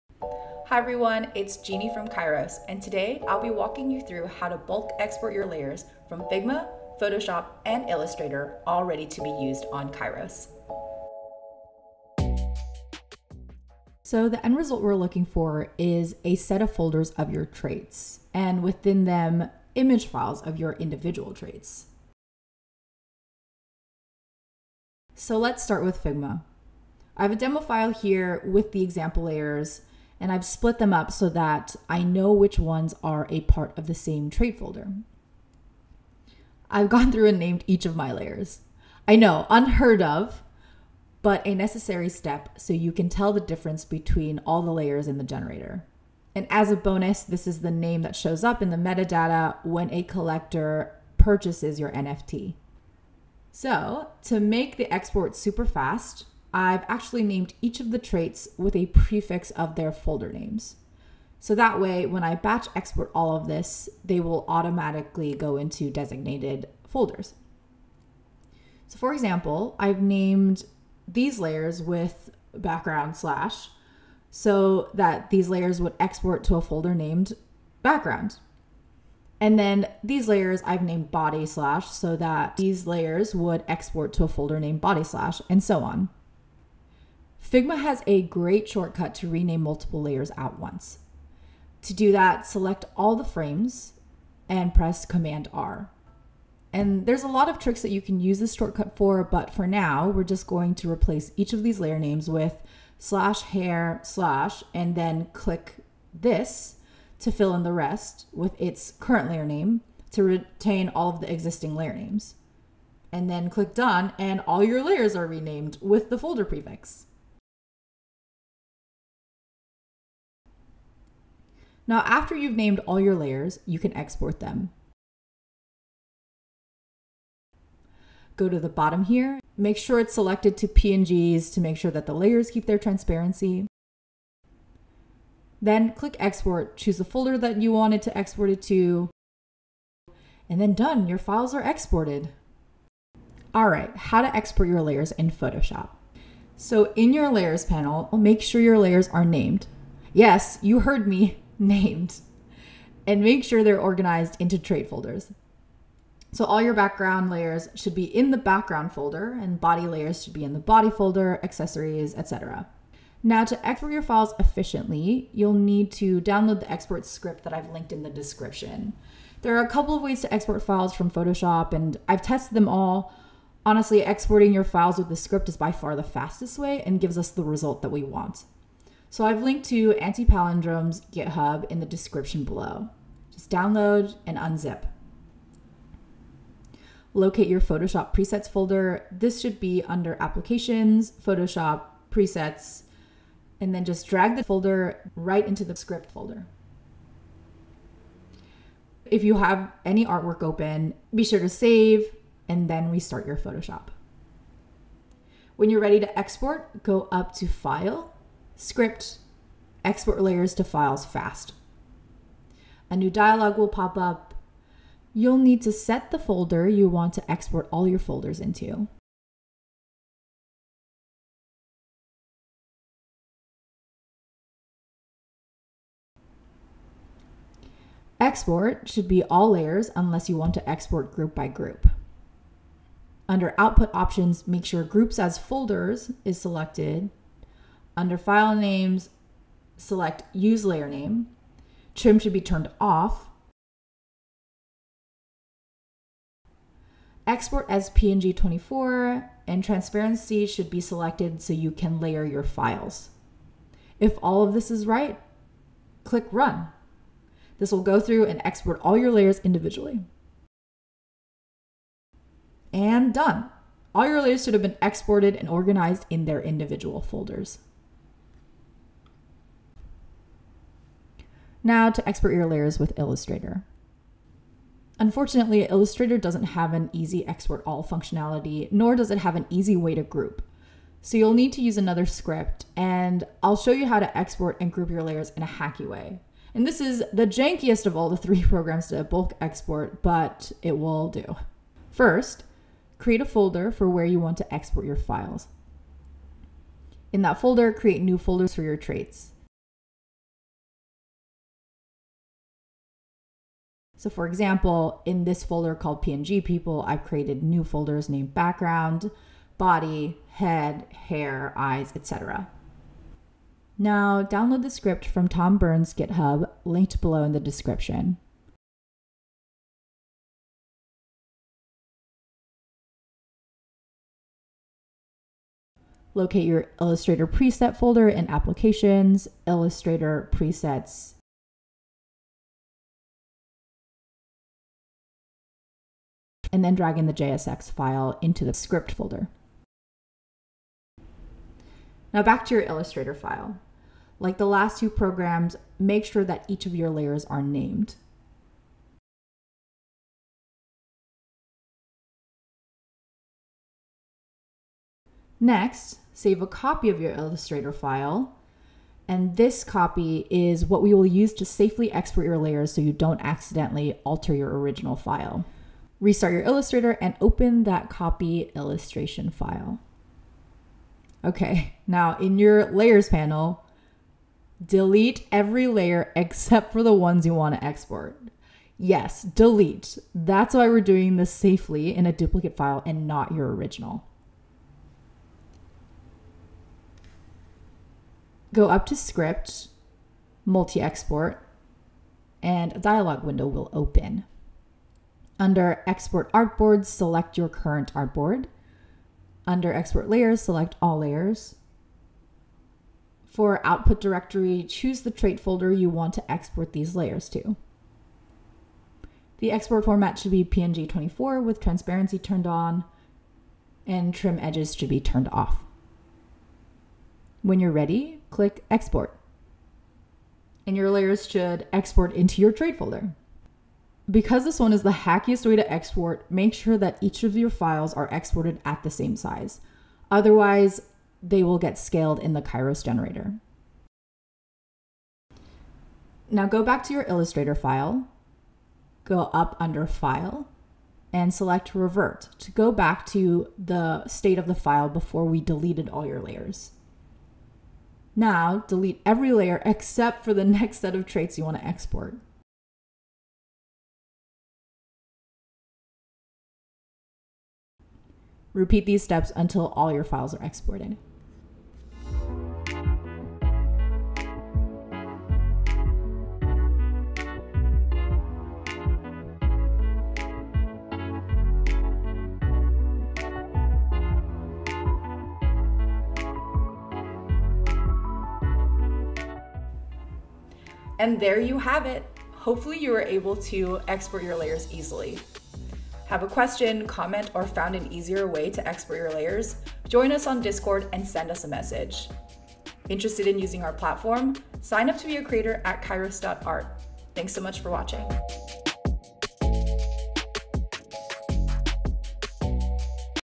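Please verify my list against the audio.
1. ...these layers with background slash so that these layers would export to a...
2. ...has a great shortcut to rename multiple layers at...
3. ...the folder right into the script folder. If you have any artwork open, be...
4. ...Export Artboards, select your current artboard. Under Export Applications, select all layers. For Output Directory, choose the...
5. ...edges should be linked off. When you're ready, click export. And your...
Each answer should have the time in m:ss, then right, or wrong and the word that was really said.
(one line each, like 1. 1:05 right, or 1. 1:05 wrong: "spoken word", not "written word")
1. 1:11 right
2. 1:27 right
3. 3:14 right
4. 6:35 wrong: "Layers", not "Applications"
5. 6:54 wrong: "turned", not "linked".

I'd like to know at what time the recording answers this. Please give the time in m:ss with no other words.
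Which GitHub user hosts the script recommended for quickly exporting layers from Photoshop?
2:59.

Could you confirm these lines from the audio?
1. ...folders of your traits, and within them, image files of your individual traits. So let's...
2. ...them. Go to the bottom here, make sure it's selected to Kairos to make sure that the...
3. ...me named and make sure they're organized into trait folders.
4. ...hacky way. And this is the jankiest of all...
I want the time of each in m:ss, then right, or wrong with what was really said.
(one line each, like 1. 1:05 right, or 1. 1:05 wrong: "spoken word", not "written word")
1. 0:16 right
2. 2:04 wrong: "PNGs", not "Kairos"
3. 2:31 right
4. 4:45 right.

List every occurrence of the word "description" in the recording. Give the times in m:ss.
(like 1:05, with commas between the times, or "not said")
2:48, 3:01, 5:17.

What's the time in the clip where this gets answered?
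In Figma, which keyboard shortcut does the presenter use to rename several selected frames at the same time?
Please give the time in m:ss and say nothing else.
1:35.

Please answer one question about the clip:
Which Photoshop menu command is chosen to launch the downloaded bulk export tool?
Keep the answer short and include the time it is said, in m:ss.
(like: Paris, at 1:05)
Export layers to files fast, at 3:29.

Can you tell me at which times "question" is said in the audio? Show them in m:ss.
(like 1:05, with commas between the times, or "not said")
8:06.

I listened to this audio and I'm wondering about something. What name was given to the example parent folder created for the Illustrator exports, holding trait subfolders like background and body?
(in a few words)
PNG people.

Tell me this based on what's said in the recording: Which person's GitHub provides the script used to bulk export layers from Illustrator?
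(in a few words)
Tom Byrne.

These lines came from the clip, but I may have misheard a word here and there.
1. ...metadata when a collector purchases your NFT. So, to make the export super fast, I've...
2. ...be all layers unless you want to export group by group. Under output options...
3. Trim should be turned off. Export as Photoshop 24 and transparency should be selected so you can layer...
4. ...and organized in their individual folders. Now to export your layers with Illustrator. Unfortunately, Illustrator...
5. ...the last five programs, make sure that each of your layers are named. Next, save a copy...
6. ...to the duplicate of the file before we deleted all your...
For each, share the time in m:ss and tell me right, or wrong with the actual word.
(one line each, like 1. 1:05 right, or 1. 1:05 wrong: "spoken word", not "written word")
1. 0:48 right
2. 3:49 right
3. 4:01 wrong: "PNG", not "Photoshop"
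4. 4:25 right
5. 5:44 wrong: "two", not "five"
6. 7:23 wrong: "state", not "duplicate".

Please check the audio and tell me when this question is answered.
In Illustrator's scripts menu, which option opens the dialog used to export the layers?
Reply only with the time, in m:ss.
6:30.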